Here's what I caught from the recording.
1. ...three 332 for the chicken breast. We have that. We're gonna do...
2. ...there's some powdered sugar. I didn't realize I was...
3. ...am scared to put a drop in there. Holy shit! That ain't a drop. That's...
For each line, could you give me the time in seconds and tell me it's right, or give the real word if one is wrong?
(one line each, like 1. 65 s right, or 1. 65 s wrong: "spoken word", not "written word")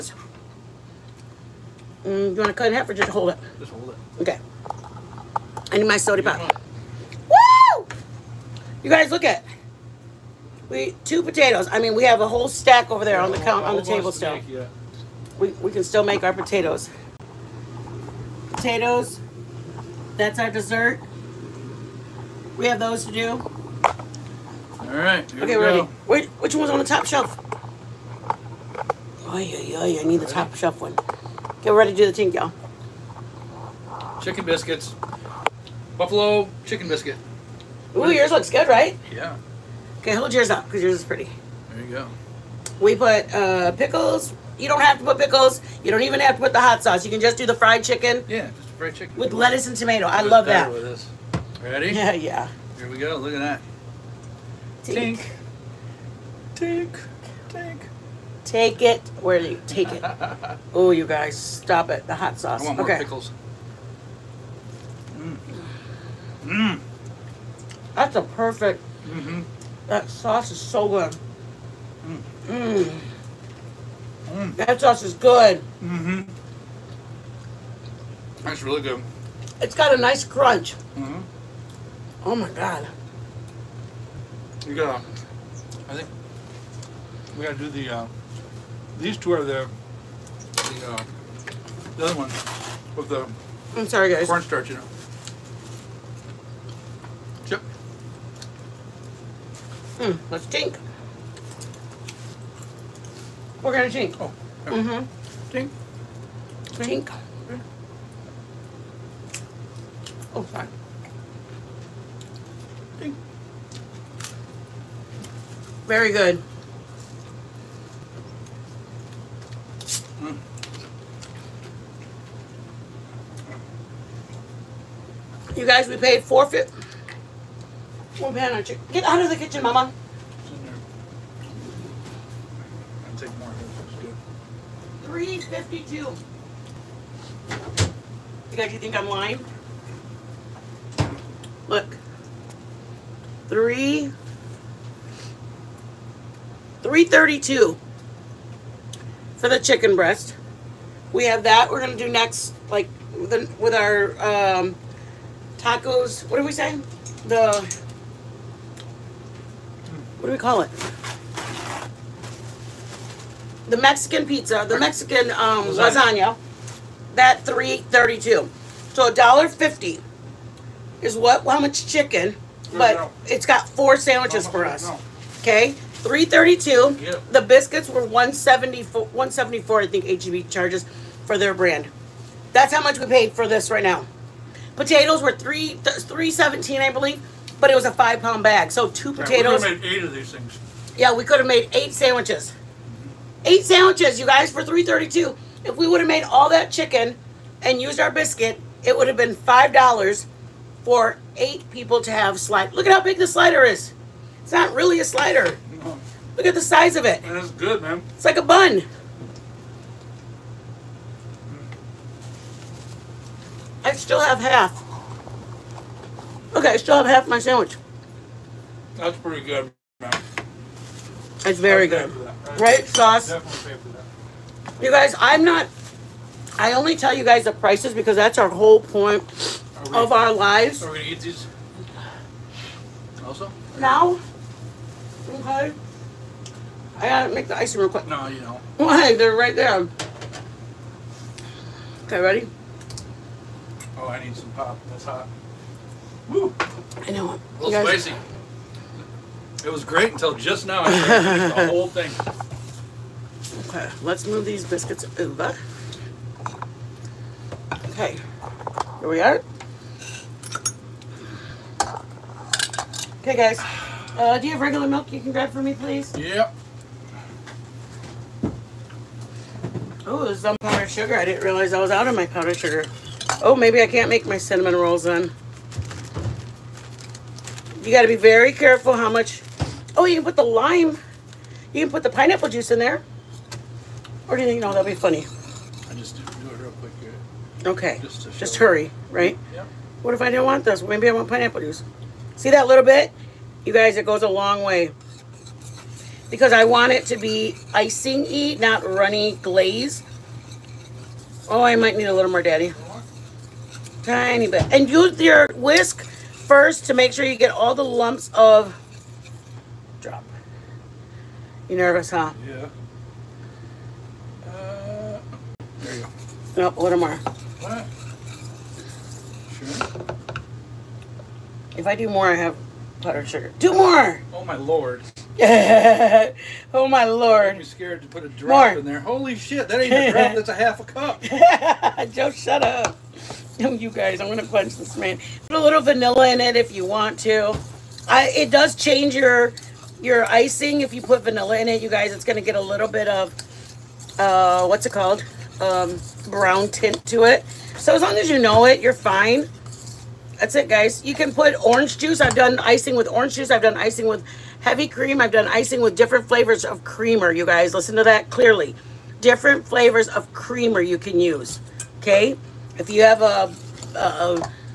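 1. 143 s right
2. 270 s right
3. 327 s right.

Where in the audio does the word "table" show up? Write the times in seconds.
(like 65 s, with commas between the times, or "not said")
13 s.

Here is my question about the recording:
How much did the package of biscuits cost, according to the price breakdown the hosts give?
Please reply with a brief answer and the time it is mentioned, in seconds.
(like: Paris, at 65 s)
$1.74, at 177 s.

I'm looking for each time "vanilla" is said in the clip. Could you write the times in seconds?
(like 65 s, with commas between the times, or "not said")
335 s, 341 s.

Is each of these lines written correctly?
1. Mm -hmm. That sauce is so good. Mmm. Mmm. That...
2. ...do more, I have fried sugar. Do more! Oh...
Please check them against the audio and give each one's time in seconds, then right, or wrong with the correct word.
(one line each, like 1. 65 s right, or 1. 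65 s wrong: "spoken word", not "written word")
1. 69 s right
2. 321 s wrong: "powdered", not "fried".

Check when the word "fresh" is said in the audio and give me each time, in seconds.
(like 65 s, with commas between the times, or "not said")
not said.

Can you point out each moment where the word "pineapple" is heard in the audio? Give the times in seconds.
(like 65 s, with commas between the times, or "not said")
282 s, 291 s.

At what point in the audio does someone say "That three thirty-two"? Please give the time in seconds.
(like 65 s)
167 s.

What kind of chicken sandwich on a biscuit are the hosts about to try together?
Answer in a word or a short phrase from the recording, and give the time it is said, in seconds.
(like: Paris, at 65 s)
Buffalo chicken biscuit, at 35 s.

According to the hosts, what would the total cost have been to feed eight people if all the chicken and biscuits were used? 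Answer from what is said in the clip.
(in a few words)
$5.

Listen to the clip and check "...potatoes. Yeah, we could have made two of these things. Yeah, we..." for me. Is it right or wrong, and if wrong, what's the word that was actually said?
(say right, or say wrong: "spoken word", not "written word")
wrong: "eight", not "two".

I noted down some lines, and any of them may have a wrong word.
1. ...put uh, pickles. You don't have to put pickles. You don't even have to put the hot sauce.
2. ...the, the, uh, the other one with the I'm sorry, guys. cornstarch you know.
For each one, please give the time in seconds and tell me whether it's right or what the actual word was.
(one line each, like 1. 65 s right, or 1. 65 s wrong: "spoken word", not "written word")
1. 42 s right
2. 89 s right.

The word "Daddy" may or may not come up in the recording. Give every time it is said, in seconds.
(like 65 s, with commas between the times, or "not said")
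302 s.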